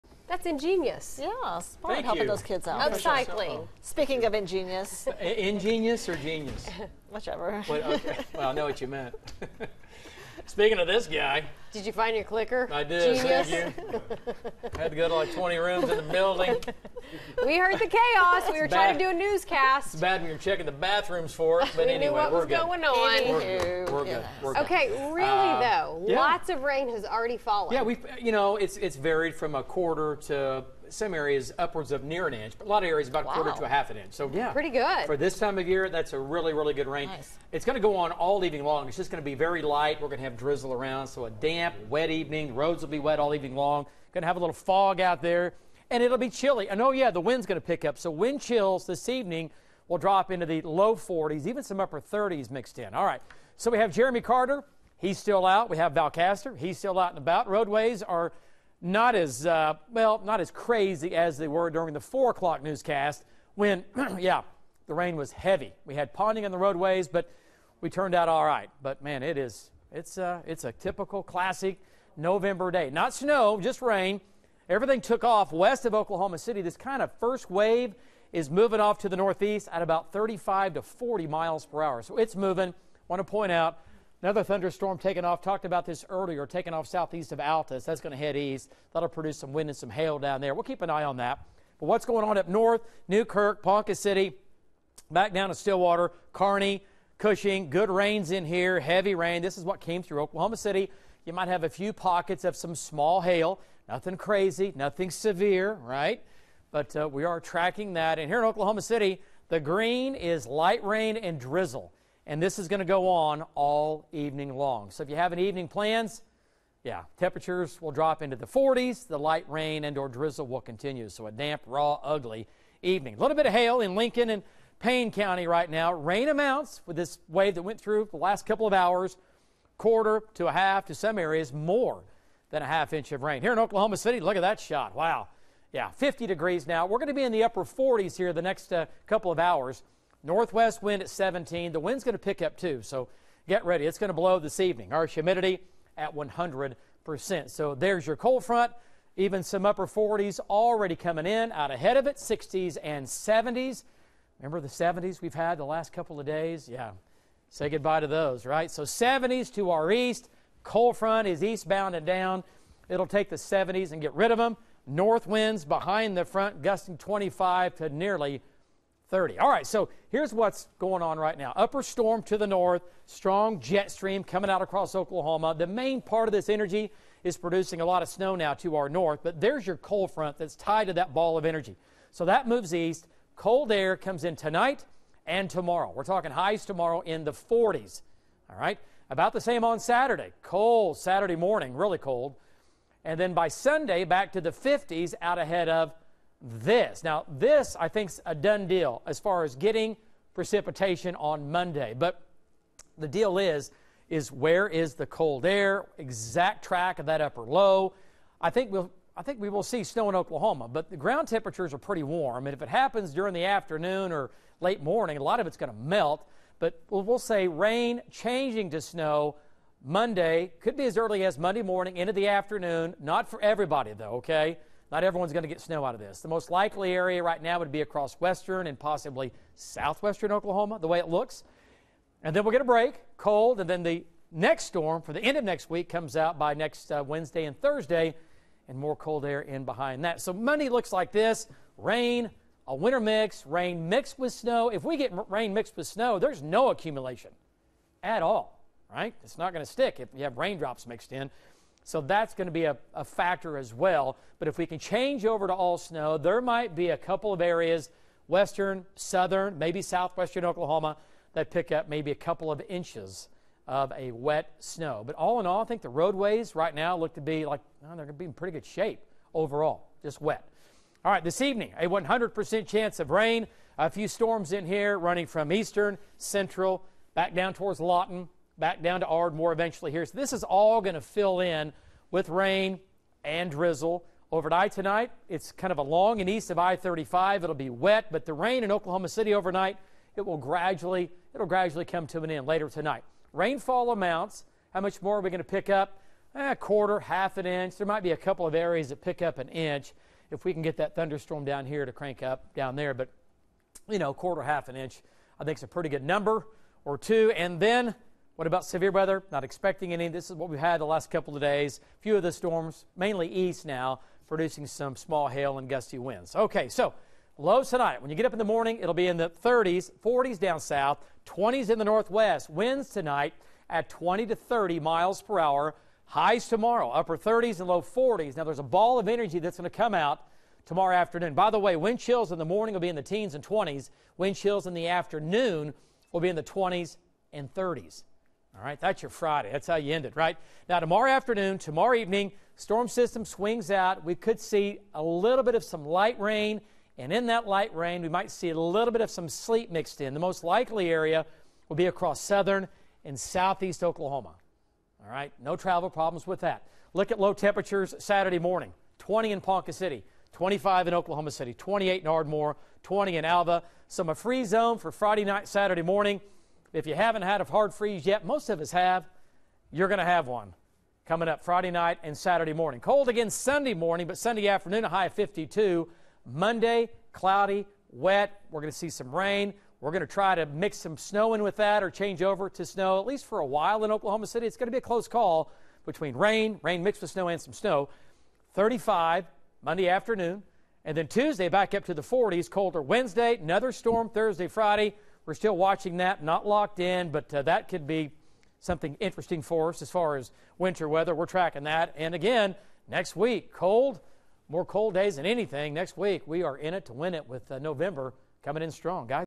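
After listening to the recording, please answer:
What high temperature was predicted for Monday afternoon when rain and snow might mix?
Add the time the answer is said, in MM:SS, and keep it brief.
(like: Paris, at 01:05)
35, at 06:28.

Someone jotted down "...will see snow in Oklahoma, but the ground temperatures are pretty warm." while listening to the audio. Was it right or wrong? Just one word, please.
right.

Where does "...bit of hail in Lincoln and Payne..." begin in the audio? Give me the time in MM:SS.
02:03.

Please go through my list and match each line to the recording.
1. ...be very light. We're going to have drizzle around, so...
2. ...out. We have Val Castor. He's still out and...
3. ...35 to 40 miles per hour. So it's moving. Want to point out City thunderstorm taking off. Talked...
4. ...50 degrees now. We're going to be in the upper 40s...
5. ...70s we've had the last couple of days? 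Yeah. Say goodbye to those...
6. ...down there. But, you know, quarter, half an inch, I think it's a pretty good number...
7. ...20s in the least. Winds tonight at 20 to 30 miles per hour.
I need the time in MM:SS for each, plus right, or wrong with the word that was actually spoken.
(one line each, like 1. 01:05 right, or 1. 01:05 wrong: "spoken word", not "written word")
1. 00:39 right
2. 00:55 right
3. 01:20 wrong: "Another", not "City"
4. 02:15 right
5. 02:34 right
6. 05:02 right
7. 05:21 wrong: "northwest", not "least".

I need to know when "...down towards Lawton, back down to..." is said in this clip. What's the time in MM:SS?
04:37.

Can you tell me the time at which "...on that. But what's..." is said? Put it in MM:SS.
01:31.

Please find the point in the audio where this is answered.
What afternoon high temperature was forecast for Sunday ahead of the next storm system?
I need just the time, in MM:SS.
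06:14.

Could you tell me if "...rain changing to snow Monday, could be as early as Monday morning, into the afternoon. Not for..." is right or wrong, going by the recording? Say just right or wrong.
right.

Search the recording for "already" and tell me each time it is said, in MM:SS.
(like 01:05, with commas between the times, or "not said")
00:27, 02:30.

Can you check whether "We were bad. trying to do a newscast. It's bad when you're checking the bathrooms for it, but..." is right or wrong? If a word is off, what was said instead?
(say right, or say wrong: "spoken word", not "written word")
right.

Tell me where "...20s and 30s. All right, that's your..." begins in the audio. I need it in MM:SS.
05:36.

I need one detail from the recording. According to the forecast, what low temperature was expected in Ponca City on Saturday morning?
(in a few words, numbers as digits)
20.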